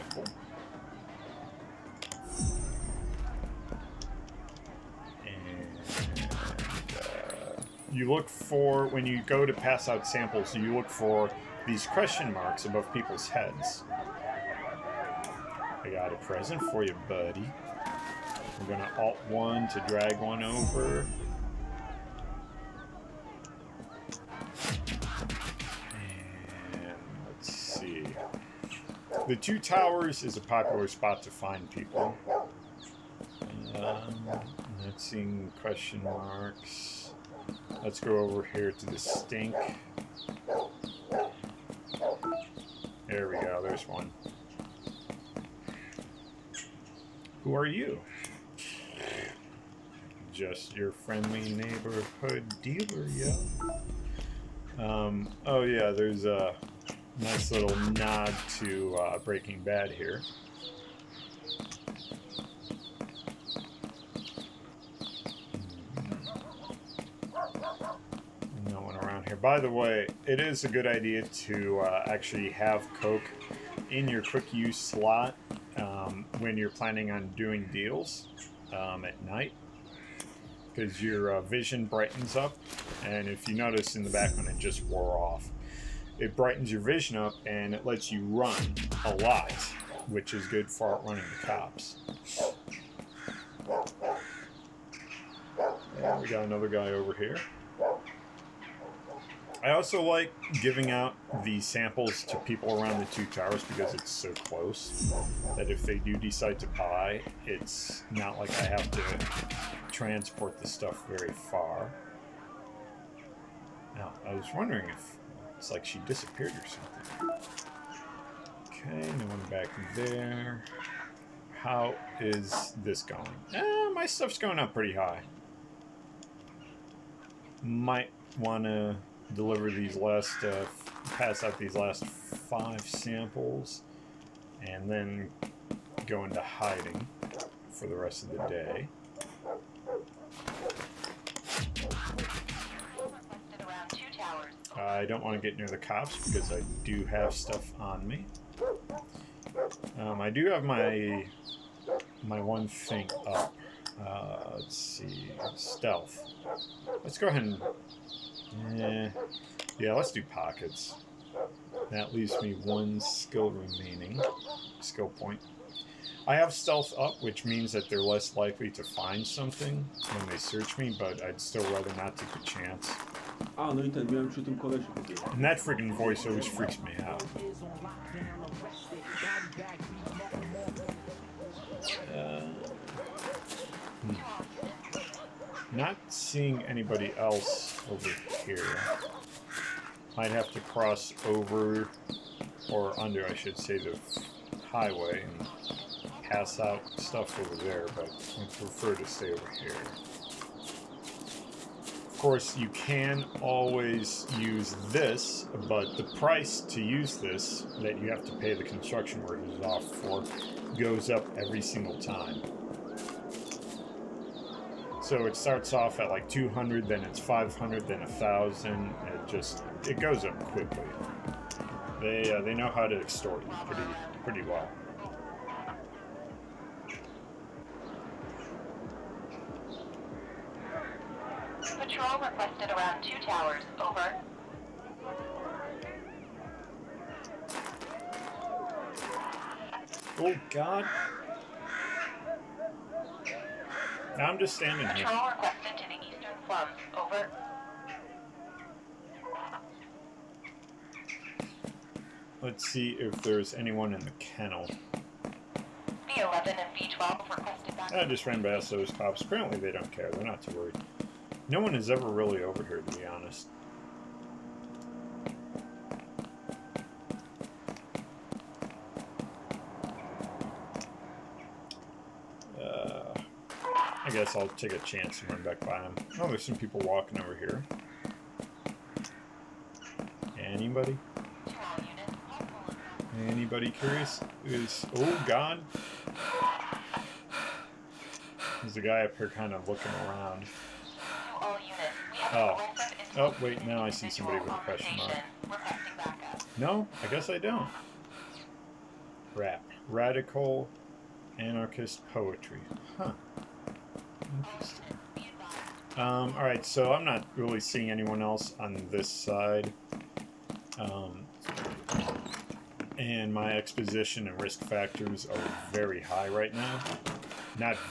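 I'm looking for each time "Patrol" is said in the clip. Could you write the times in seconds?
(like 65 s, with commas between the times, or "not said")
231 s.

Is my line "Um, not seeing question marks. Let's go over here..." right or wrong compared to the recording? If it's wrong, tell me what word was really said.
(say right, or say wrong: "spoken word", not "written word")
right.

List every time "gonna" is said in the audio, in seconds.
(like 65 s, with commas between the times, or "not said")
18 s.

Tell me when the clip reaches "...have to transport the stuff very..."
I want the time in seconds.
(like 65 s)
108 s.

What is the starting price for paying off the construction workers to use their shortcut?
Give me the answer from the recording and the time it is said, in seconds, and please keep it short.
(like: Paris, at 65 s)
200, at 216 s.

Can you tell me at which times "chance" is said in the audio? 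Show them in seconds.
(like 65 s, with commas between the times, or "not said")
172 s, 274 s.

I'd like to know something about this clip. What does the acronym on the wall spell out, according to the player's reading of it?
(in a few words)
Radical anarchist poetry.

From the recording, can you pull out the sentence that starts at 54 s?
Um, oh yeah, there's a nice little nod to uh, Breaking Bad here.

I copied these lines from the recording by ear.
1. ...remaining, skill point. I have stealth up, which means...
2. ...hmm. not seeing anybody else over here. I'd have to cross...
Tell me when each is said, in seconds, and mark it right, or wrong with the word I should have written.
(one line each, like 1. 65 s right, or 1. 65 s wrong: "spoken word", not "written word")
1. 163 s right
2. 184 s right.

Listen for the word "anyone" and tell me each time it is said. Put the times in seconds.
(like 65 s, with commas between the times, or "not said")
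253 s, 307 s.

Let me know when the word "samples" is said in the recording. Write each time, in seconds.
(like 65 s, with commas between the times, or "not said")
10 s, 101 s, 132 s.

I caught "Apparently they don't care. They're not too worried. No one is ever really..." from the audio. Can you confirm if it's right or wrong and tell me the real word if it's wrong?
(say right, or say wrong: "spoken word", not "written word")
right.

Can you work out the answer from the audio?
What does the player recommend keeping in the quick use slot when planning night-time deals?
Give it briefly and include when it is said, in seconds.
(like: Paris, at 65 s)
Coke, at 73 s.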